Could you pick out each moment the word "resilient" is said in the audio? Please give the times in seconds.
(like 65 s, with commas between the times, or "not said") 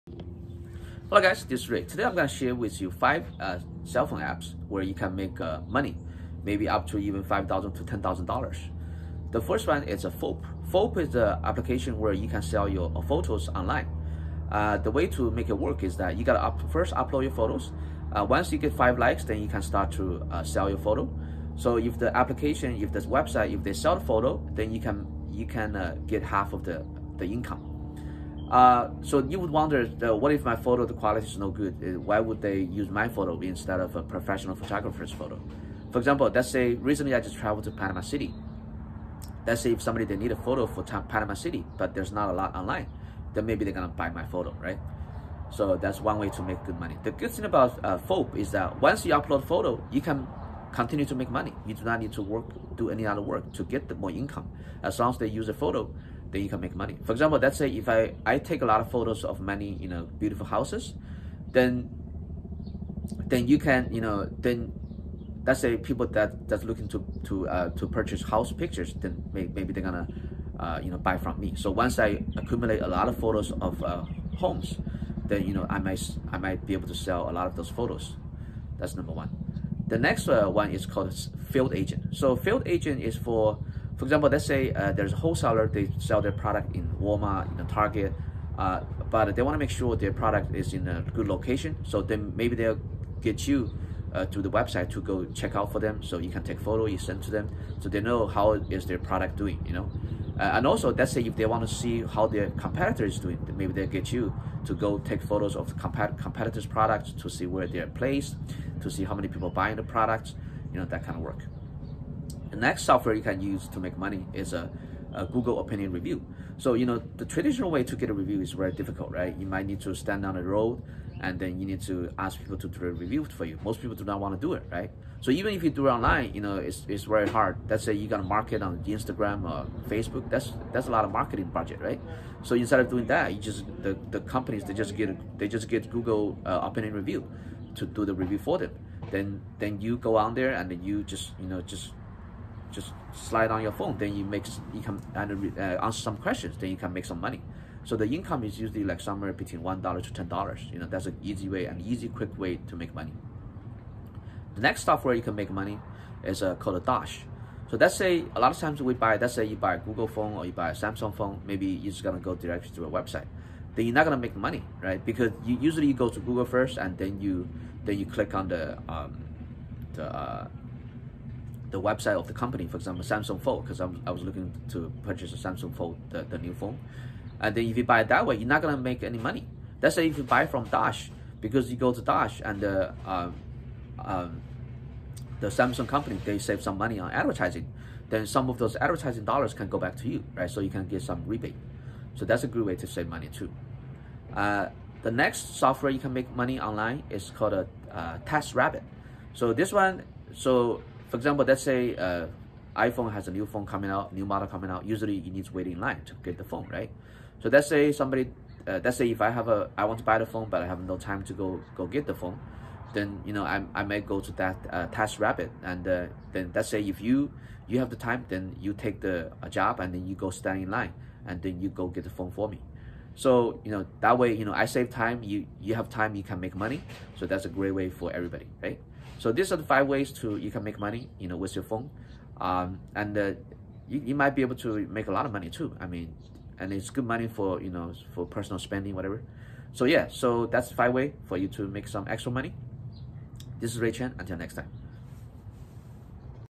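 not said.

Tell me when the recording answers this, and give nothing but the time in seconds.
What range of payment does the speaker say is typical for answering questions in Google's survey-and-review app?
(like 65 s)
149 s.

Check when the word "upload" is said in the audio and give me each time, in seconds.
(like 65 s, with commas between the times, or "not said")
16 s, 49 s.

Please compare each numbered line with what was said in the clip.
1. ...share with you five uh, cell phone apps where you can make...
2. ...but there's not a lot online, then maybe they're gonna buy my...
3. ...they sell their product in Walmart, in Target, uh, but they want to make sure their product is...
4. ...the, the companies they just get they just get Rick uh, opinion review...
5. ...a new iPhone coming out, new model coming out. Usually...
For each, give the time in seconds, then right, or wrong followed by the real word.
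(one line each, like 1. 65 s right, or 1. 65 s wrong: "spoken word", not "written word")
1. 2 s right
2. 41 s right
3. 85 s right
4. 133 s wrong: "Google", not "Rick"
5. 203 s wrong: "phone", not "iPhone".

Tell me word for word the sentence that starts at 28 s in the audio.
Uh, so you would wonder, uh, what if my photo, the quality is no good?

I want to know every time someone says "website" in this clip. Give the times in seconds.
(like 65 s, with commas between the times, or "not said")
23 s, 94 s, 162 s, 171 s.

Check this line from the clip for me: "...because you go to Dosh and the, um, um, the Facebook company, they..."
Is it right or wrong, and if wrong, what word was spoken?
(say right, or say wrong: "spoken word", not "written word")
wrong: "Samsung", not "Facebook".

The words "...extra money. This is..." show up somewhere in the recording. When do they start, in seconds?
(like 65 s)
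242 s.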